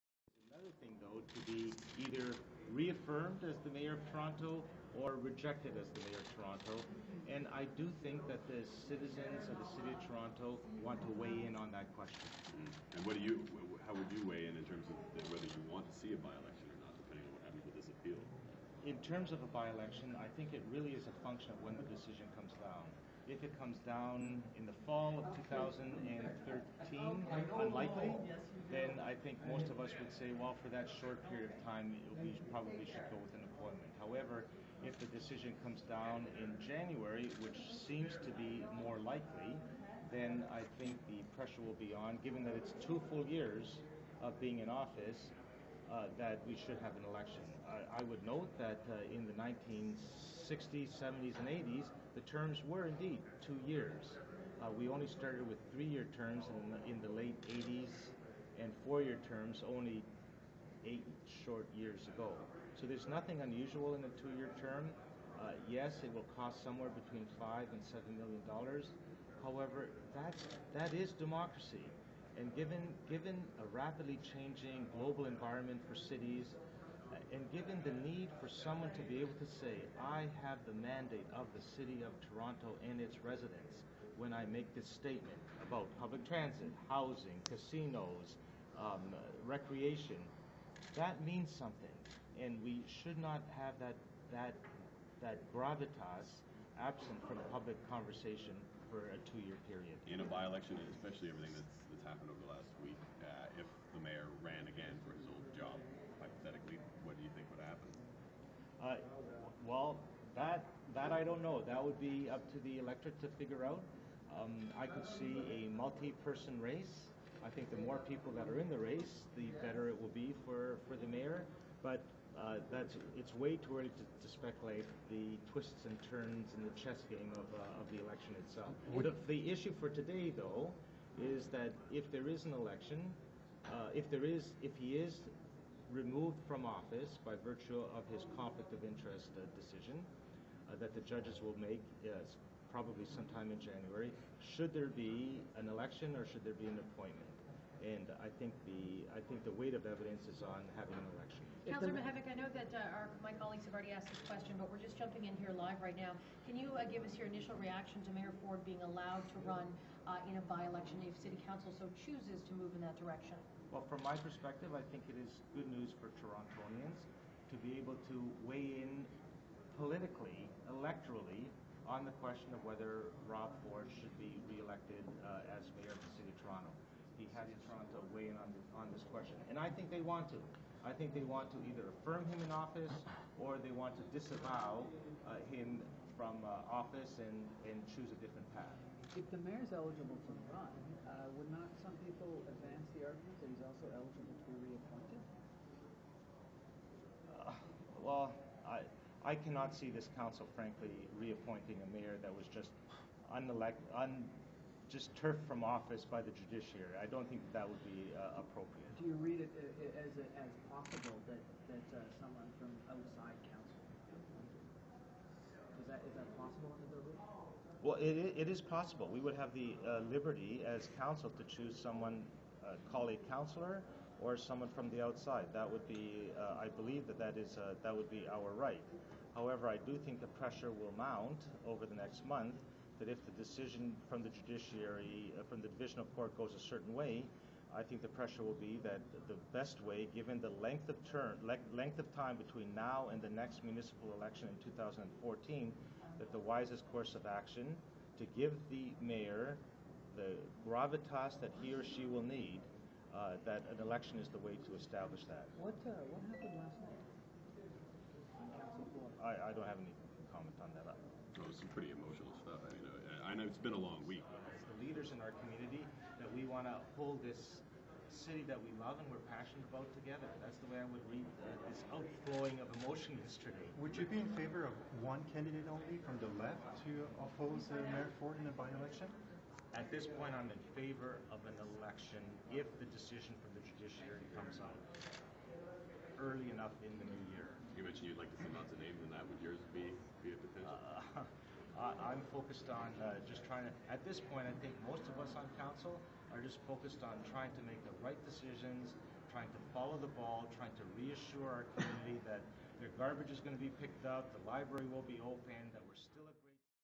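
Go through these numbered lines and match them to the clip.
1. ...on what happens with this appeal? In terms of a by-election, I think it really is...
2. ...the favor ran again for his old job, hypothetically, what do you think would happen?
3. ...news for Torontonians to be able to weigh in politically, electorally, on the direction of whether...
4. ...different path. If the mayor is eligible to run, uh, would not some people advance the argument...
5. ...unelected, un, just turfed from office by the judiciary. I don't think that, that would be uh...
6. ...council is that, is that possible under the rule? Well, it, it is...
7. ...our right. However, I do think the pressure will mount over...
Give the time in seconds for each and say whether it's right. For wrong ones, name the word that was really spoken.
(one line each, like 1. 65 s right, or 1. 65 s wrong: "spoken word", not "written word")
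1. 17 s right
2. 103 s wrong: "mayor", not "favor"
3. 165 s wrong: "question", not "direction"
4. 188 s right
5. 203 s right
6. 213 s right
7. 228 s right.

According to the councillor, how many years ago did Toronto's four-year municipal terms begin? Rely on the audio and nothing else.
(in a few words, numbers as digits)
8.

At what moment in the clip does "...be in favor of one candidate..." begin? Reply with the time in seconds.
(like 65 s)
274 s.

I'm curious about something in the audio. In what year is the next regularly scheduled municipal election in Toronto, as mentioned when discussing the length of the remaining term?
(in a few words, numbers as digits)
2014.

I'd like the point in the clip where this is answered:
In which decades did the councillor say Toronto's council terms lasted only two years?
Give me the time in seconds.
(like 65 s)
49 s.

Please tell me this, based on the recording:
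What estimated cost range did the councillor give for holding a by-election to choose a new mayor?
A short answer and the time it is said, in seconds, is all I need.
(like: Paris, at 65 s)
5 to 7 million dollars, at 67 s.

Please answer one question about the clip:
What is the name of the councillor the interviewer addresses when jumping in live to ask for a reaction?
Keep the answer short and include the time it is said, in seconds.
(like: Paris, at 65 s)
Mihevc, at 151 s.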